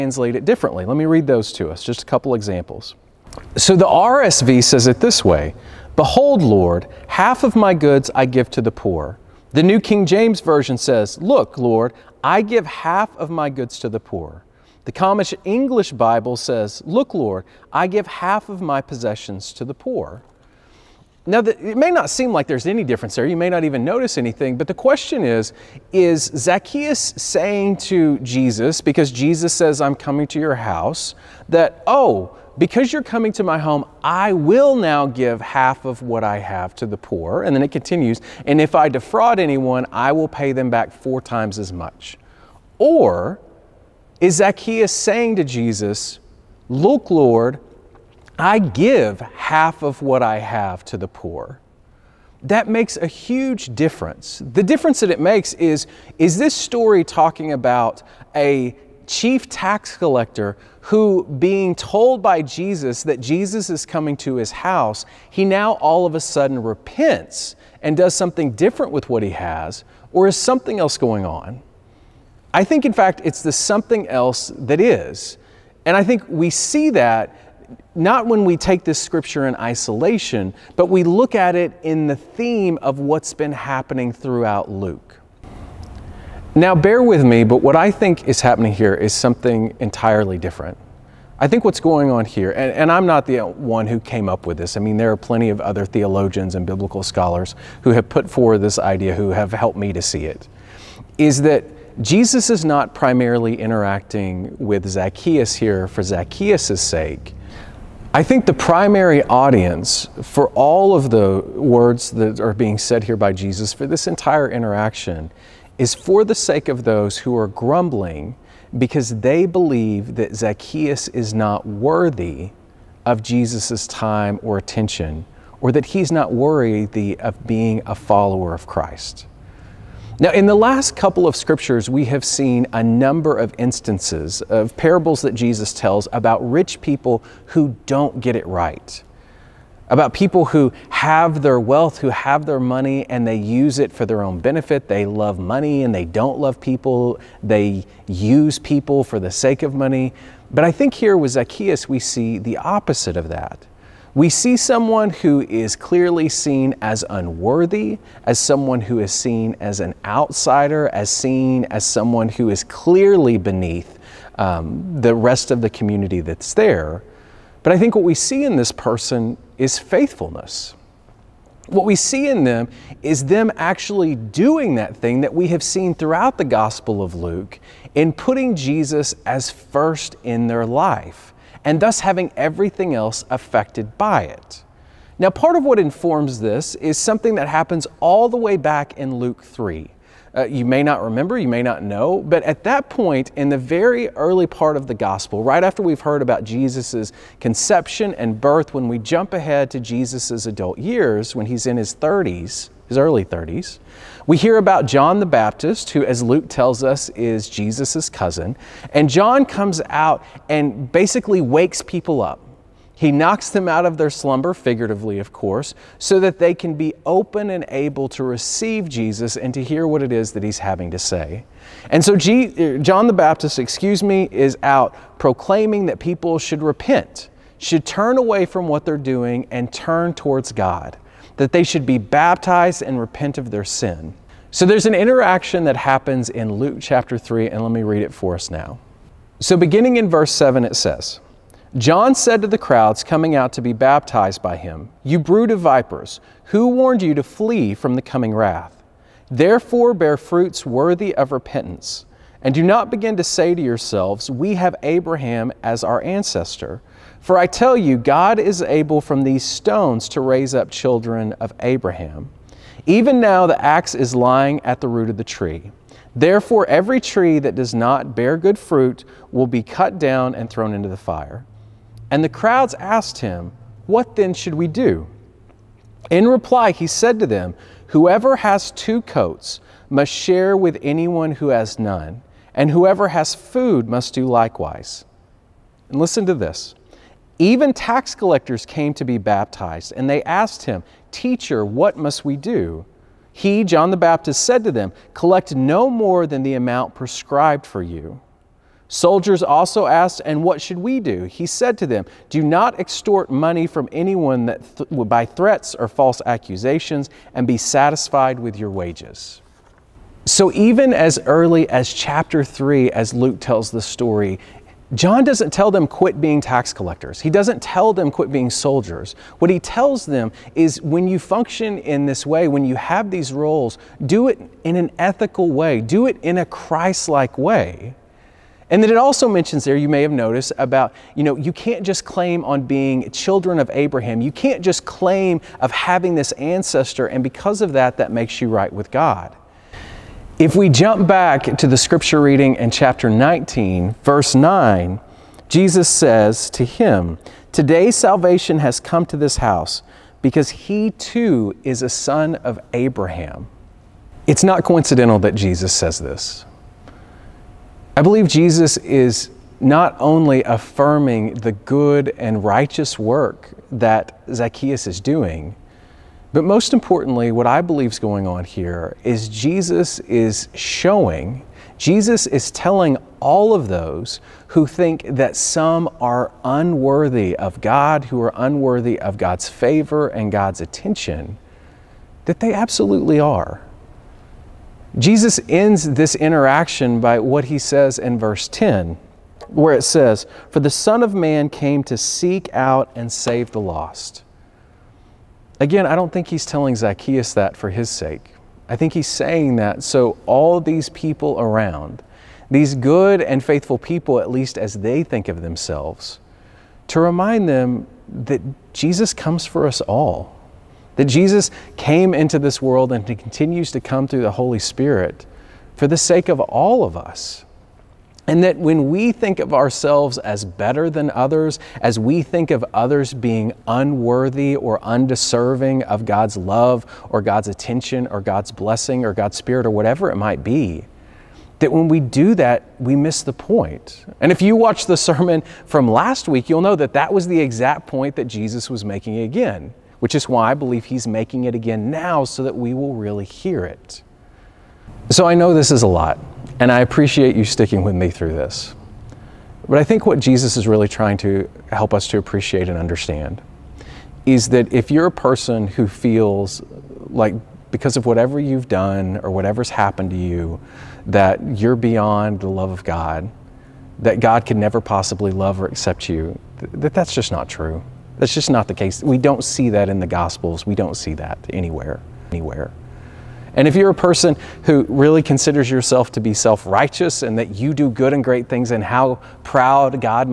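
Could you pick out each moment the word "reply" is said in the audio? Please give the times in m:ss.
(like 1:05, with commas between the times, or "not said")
4:36.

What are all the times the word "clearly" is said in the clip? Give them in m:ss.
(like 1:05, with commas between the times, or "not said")
2:35, 2:42.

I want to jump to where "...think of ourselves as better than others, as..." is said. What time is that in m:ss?
6:59.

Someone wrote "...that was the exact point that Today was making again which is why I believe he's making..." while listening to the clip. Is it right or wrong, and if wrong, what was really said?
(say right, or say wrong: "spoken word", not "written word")
wrong: "Jesus", not "Today".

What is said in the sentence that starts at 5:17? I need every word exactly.
He doesn't tell them quit being soldiers.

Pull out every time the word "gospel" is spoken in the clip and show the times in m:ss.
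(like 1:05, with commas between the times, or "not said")
2:56, 3:14, 7:50.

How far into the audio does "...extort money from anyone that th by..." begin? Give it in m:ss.
5:02.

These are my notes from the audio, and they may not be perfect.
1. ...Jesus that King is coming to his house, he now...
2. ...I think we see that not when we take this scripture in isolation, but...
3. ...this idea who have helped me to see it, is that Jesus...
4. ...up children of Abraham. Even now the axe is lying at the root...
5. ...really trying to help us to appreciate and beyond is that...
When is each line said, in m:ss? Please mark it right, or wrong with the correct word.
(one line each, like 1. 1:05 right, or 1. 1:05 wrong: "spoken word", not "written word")
1. 1:02 wrong: "Jesus", not "King"
2. 1:15 right
3. 1:38 right
4. 4:20 right
5. 7:30 wrong: "understand", not "beyond".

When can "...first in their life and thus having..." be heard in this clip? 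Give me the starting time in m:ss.
2:59.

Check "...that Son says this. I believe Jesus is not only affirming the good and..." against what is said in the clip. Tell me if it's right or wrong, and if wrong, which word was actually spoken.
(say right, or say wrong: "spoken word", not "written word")
wrong: "Jesus", not "Son".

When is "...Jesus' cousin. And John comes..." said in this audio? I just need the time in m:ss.
3:27.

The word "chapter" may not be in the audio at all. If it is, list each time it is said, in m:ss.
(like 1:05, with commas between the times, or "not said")
3:56, 5:11, 5:42.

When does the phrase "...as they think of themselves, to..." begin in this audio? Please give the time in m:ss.
6:44.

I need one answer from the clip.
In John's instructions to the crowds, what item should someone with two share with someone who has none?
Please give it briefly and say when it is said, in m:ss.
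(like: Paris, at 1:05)
coats, at 4:38.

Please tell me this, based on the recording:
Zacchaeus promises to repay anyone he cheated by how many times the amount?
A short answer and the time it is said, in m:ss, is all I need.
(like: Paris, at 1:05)
4, at 0:40.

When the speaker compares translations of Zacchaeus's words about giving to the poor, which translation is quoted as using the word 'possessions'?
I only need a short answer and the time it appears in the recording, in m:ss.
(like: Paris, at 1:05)
Common English Bible, at 0:14.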